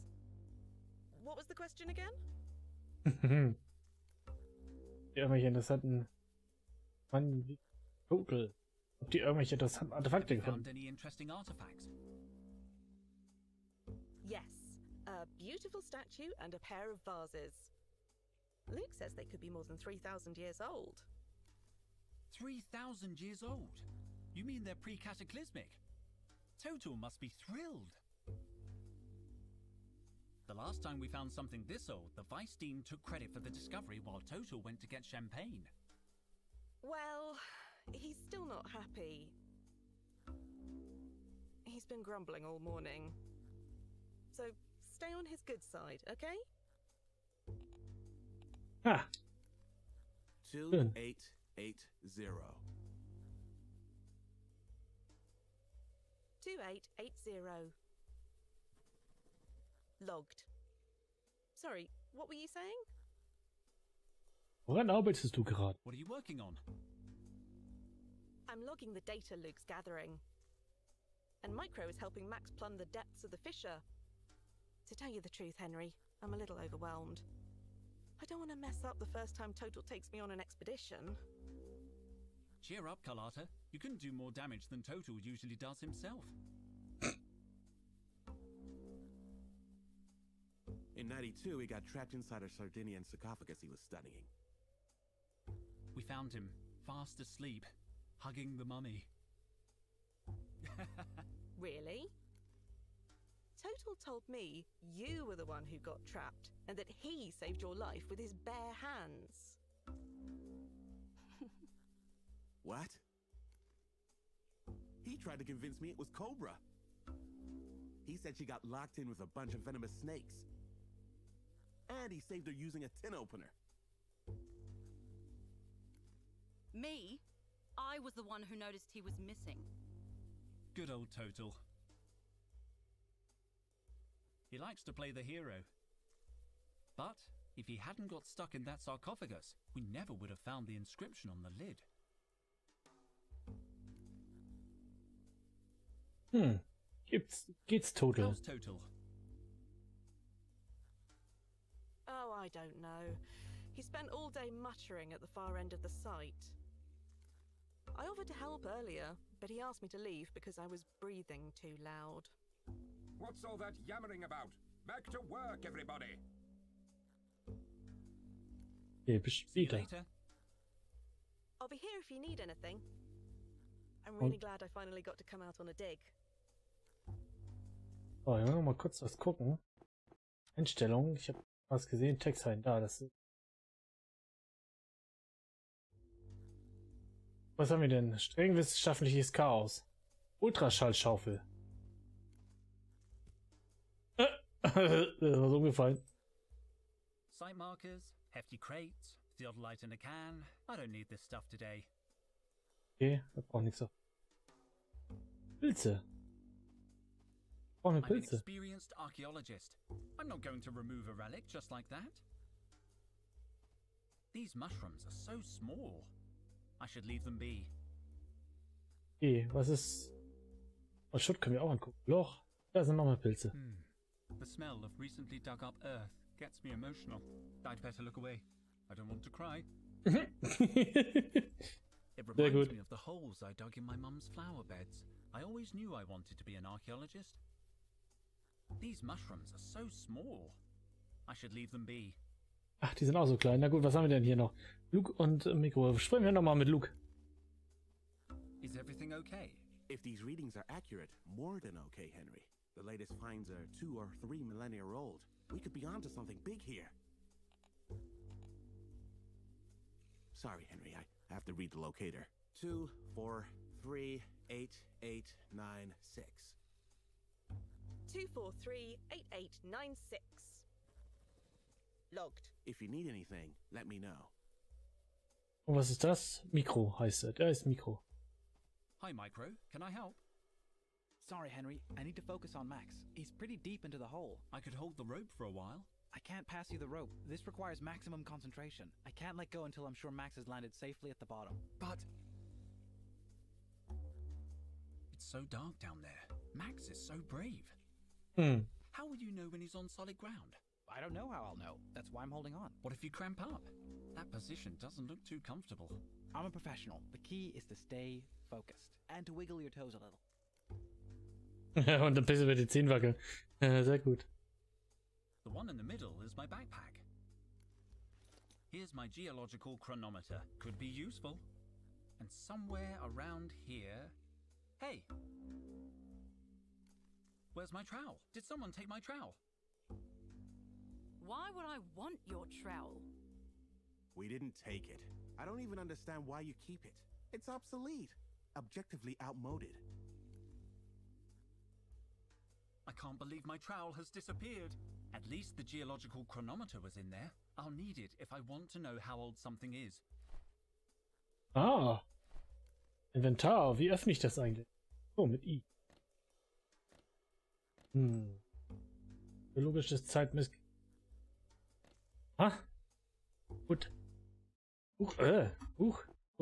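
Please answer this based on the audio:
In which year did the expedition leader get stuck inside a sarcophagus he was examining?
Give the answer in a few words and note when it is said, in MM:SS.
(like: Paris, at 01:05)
1992, at 01:31.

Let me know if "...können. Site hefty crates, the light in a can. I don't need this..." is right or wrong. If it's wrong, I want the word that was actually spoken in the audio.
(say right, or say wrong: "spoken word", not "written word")
wrong: "umgefallen", not "können".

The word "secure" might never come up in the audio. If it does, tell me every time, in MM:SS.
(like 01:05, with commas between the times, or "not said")
not said.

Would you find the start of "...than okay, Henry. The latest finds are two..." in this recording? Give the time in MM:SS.
04:11.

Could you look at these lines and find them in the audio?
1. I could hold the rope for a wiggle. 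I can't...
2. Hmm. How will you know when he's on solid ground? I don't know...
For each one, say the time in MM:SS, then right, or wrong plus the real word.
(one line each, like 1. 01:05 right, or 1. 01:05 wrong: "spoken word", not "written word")
1. 04:44 wrong: "while", not "wiggle"
2. 04:58 right.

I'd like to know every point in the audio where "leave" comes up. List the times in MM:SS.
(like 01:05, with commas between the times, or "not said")
02:39, 03:37, 04:01.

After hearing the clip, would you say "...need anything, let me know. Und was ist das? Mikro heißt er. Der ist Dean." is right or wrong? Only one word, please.
wrong.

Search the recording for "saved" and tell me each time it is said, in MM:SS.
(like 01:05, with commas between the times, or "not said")
01:47, 02:02.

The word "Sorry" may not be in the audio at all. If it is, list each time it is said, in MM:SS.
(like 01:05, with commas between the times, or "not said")
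01:01, 04:20, 04:41.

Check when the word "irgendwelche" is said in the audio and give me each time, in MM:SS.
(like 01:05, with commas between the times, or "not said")
00:05, 00:09.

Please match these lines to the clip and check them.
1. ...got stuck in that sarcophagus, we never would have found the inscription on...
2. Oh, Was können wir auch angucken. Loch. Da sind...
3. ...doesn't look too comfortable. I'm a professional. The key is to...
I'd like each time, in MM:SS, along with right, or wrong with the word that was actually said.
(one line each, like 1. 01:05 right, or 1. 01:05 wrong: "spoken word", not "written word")
1. 02:18 right
2. 03:41 wrong: "Schutt", not "Was"
3. 05:04 right.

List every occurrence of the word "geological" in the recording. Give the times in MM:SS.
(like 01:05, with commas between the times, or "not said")
05:19, 05:45.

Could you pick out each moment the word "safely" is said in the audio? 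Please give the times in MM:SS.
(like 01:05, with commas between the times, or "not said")
04:50.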